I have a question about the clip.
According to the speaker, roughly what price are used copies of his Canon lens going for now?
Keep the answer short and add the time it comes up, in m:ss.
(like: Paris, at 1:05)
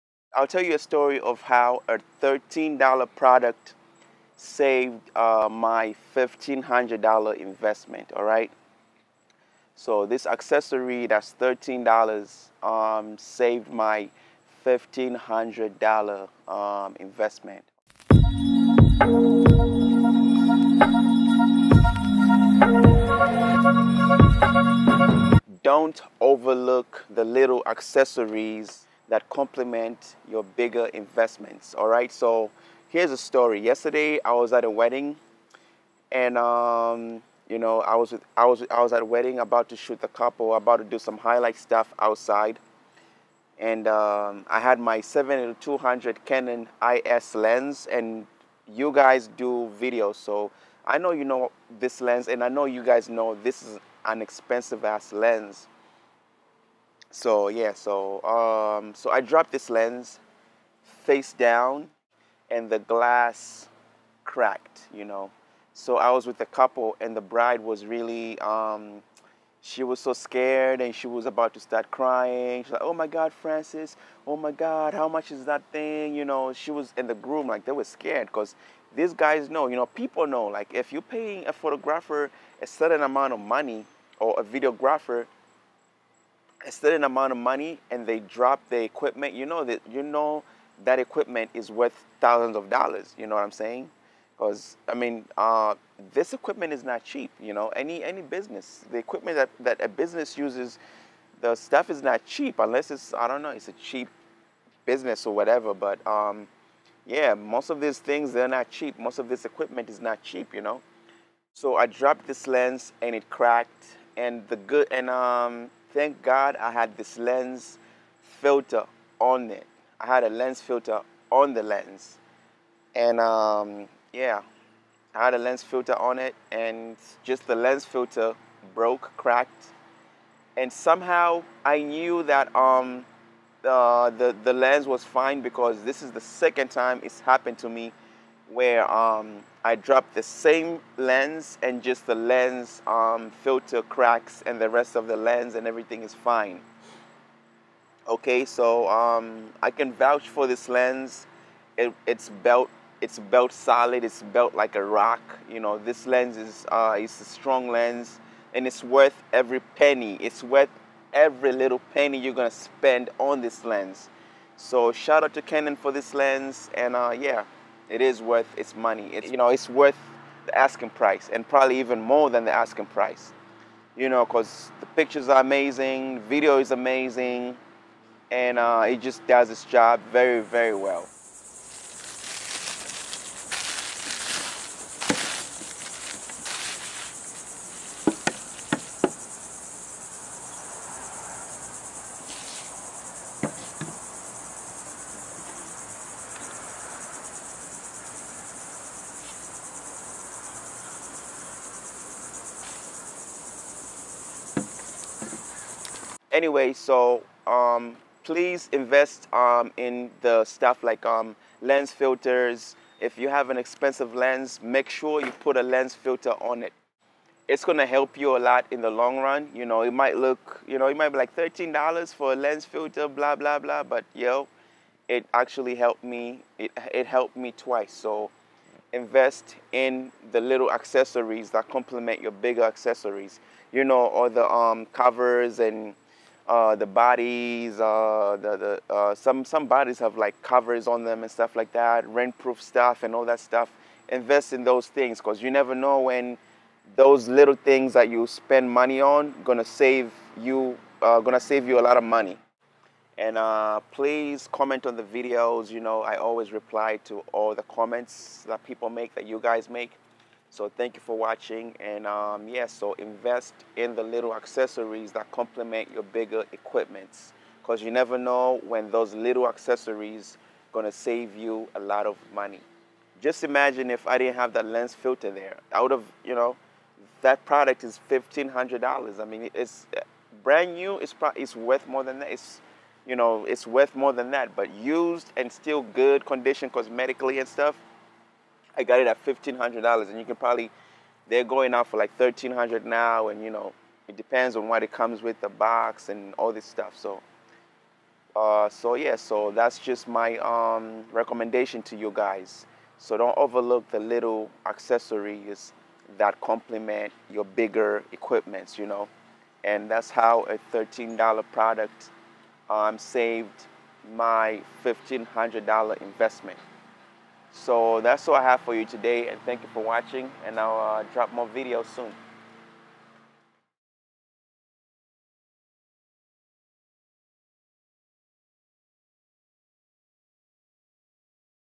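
$1,300, at 4:52.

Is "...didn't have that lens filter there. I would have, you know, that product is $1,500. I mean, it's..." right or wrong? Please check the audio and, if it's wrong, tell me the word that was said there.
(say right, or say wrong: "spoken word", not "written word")
right.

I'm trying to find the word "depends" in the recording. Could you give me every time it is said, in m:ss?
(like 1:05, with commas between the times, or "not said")
4:54.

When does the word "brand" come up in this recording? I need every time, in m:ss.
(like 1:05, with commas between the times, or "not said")
4:40.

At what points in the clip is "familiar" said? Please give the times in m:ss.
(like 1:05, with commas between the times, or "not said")
not said.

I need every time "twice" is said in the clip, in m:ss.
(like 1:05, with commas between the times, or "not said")
3:47.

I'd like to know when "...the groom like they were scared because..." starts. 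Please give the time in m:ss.
1:17.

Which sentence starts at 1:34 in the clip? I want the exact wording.
Because I mean, uh, this equipment is not cheap.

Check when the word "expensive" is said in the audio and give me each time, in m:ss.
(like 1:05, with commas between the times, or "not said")
0:54, 3:33.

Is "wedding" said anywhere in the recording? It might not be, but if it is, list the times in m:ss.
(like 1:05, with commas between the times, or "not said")
0:34, 0:39.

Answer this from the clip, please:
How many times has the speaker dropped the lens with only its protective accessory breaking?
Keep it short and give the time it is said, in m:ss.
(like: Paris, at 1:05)
2, at 2:16.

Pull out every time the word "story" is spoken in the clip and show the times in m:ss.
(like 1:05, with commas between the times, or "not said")
0:00, 0:33.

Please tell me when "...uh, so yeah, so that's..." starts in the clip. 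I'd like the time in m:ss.
4:58.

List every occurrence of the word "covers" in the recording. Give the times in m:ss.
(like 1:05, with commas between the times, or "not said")
3:54, 4:00.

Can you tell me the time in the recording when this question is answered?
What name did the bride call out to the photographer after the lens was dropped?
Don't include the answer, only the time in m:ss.
1:13.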